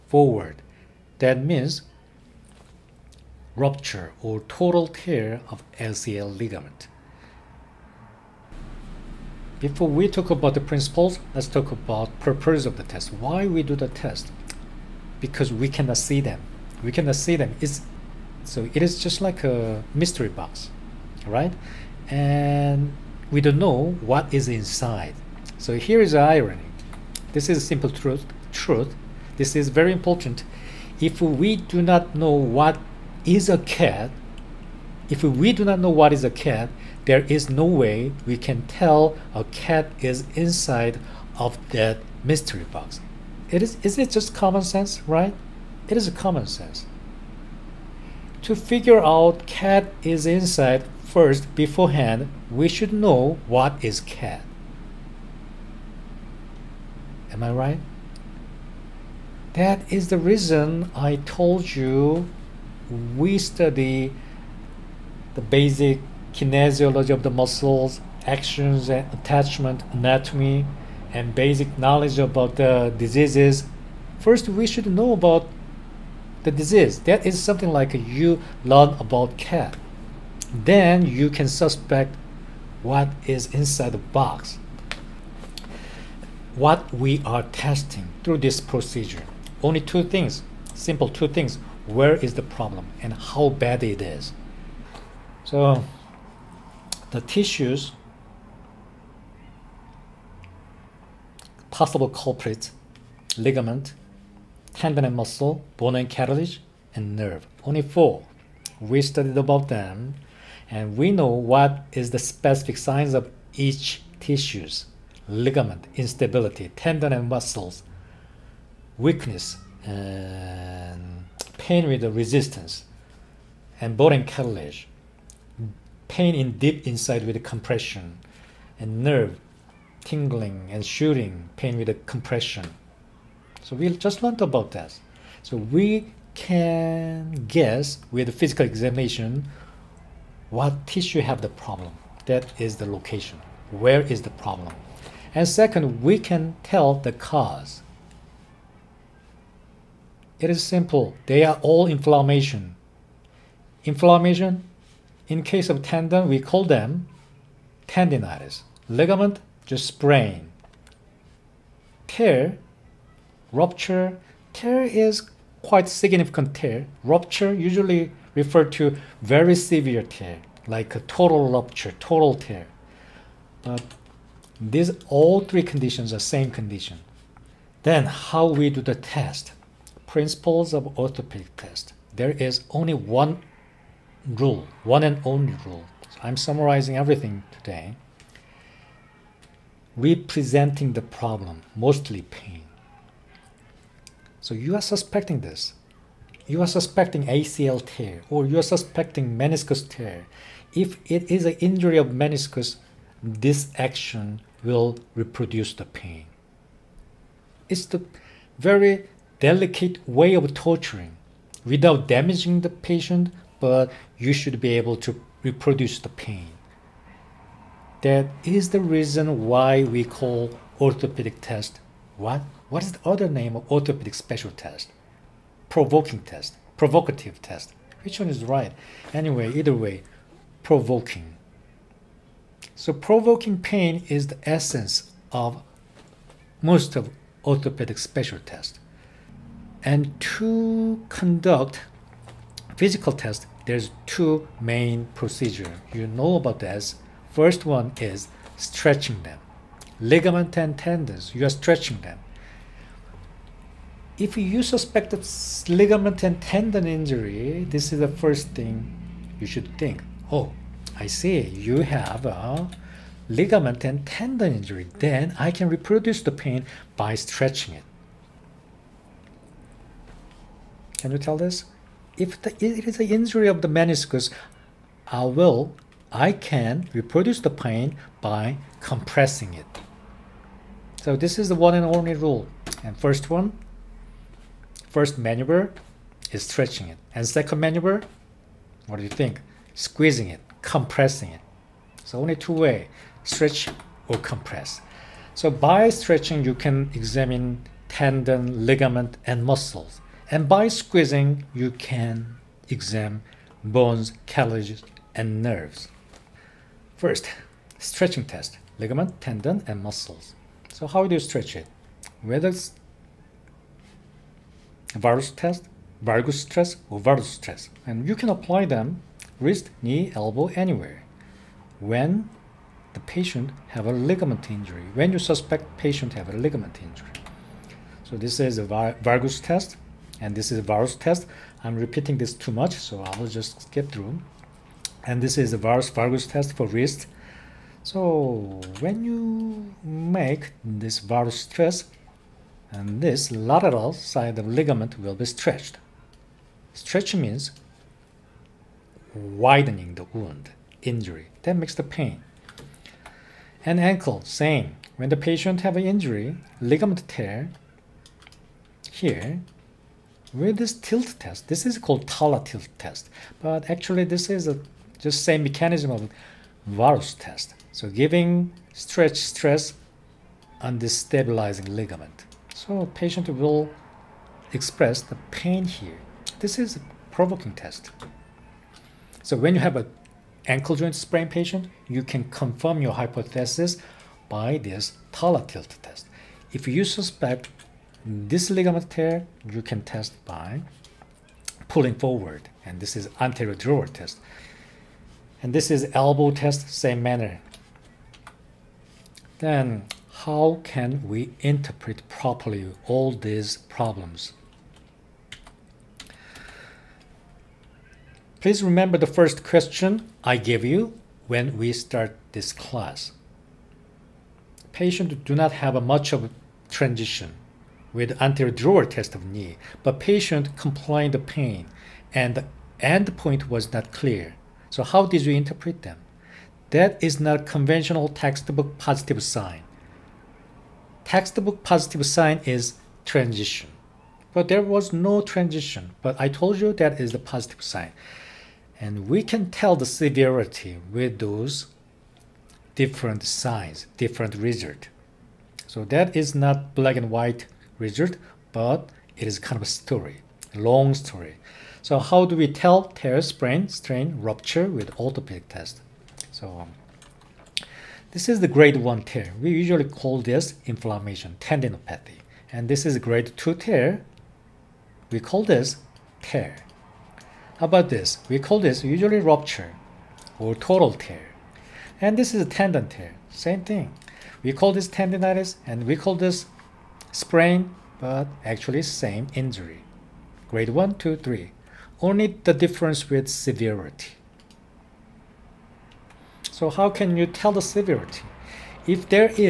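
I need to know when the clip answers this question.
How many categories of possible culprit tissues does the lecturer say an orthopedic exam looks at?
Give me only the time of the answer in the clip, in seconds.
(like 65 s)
107 s.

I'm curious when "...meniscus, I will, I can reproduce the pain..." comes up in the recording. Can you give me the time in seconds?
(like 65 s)
273 s.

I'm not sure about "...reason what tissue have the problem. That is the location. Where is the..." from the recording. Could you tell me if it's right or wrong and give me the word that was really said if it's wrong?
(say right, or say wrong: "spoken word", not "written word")
wrong: "examination", not "reason".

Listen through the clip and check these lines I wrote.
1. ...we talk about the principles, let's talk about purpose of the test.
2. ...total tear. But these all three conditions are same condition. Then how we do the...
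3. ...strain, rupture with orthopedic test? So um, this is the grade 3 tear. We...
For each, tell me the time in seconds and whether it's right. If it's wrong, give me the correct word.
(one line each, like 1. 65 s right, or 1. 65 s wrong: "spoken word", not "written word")
1. 9 s right
2. 172 s right
3. 453 s wrong: "1", not "3".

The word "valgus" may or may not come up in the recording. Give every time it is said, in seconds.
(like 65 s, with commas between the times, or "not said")
316 s, 329 s.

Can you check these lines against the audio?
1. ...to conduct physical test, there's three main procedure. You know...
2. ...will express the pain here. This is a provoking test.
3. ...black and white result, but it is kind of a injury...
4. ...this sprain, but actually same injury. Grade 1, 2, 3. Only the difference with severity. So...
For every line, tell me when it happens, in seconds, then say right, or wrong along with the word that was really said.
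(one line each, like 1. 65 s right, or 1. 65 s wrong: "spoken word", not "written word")
1. 240 s wrong: "two", not "three"
2. 373 s right
3. 446 s wrong: "story", not "injury"
4. 476 s right.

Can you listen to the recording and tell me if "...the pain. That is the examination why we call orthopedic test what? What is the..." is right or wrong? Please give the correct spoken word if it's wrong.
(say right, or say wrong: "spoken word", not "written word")
wrong: "reason", not "examination".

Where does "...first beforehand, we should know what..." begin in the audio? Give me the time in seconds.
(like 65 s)
51 s.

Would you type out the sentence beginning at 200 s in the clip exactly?
If it is an injury of meniscus, this action will reproduce the pain.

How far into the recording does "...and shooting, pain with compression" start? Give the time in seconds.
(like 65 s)
130 s.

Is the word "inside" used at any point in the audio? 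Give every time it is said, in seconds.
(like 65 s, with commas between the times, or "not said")
24 s, 40 s, 50 s, 83 s, 126 s.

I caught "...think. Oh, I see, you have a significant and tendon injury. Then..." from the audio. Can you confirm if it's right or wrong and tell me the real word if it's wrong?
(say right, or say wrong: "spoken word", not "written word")
wrong: "ligament", not "significant".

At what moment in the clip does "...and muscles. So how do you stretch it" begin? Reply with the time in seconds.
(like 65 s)
309 s.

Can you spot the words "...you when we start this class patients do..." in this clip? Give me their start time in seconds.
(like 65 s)
410 s.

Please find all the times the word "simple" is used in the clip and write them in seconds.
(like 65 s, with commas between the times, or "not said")
27 s, 90 s, 150 s.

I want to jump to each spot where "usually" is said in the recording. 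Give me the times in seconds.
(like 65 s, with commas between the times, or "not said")
167 s, 459 s, 468 s.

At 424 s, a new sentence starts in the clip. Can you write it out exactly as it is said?
So how did you interpret them?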